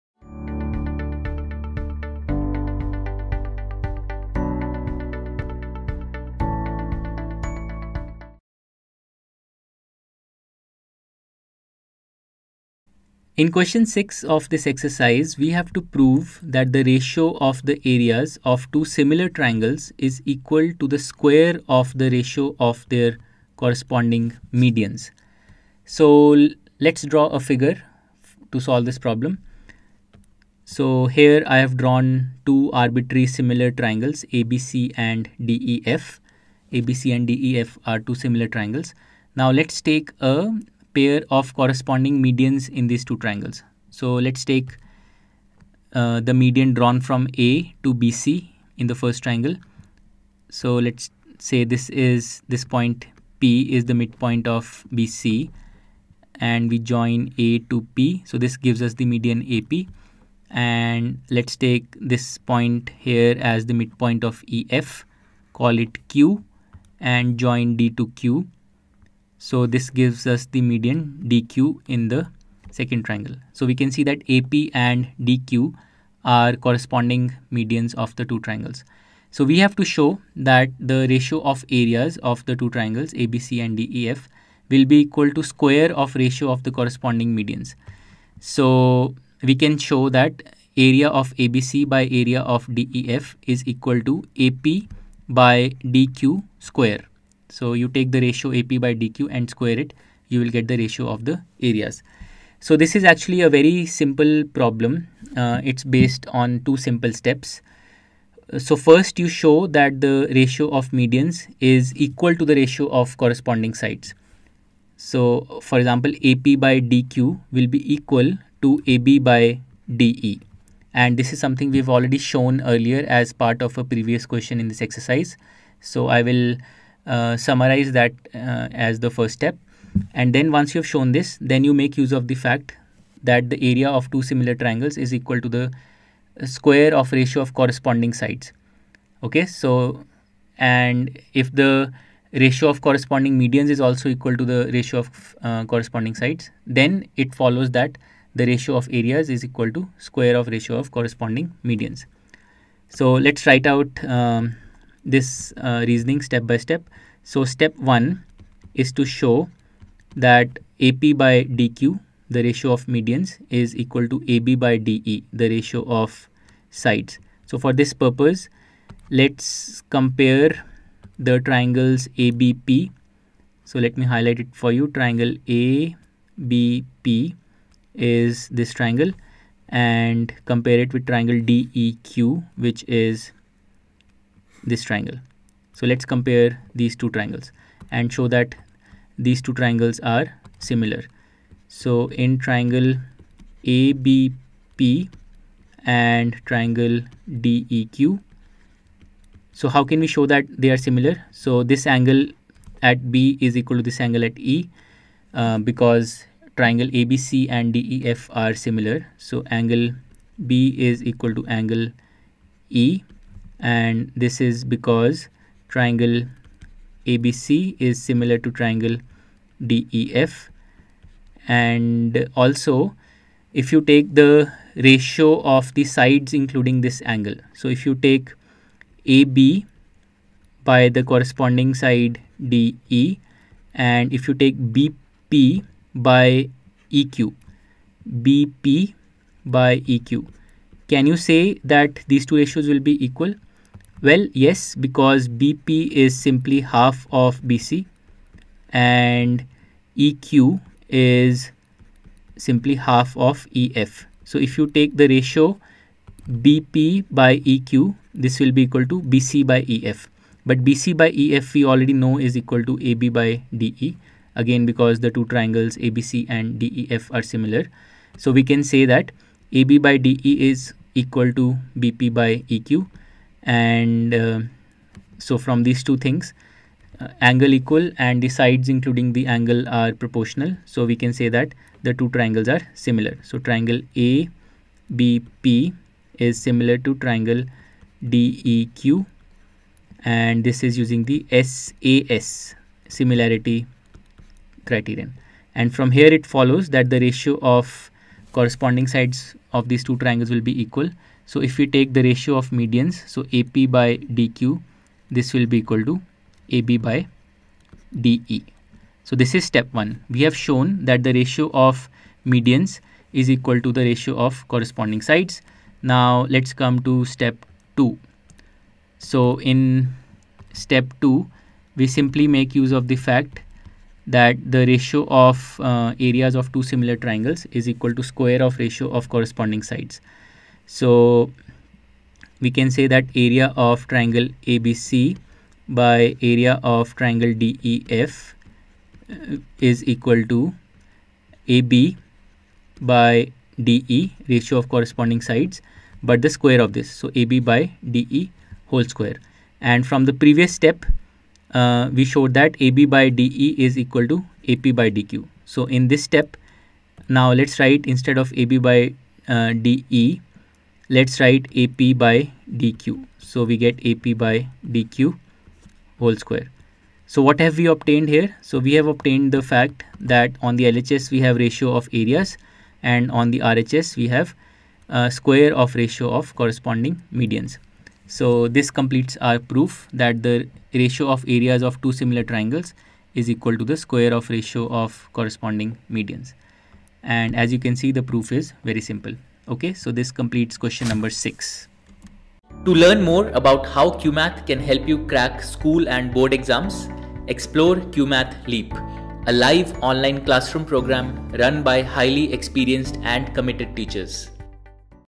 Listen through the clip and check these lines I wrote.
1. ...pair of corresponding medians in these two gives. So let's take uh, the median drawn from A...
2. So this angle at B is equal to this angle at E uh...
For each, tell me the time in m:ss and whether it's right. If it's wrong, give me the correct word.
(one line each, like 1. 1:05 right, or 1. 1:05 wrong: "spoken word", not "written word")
1. 0:40 wrong: "triangles", not "gives"
2. 3:21 right.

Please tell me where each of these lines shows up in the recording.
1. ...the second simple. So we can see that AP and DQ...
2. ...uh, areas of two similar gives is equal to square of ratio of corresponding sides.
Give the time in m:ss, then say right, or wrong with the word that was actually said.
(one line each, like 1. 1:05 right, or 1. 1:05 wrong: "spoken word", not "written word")
1. 1:12 wrong: "triangle", not "simple"
2. 5:25 wrong: "triangles", not "gives".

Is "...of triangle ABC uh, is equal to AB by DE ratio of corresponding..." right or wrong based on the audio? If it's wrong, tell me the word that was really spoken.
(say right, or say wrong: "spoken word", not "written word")
wrong: "DEF", not "ABC".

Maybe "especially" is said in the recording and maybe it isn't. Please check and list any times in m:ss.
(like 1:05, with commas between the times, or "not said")
not said.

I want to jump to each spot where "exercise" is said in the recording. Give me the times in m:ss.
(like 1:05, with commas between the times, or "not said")
0:14, 2:04.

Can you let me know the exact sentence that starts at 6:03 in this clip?
So we get AP by DQ whole square.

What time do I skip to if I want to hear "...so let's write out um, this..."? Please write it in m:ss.
2:32.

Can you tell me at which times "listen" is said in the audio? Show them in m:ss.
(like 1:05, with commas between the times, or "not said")
not said.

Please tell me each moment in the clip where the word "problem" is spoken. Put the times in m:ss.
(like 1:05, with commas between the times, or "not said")
0:28, 1:44.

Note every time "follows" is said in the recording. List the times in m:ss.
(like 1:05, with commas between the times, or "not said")
2:27, 4:56.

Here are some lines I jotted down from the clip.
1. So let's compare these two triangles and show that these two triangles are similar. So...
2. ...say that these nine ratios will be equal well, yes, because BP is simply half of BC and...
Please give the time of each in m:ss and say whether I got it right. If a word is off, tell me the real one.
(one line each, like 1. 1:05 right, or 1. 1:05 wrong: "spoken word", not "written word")
1. 3:05 right
2. 4:01 wrong: "two", not "nine".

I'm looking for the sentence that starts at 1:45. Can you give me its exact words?
Uh, it's based on two simple steps.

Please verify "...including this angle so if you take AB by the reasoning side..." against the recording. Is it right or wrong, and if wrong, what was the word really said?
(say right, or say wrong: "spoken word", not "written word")
wrong: "corresponding", not "reasoning".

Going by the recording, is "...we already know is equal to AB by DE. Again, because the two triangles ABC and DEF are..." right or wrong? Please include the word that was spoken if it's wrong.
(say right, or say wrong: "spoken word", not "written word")
right.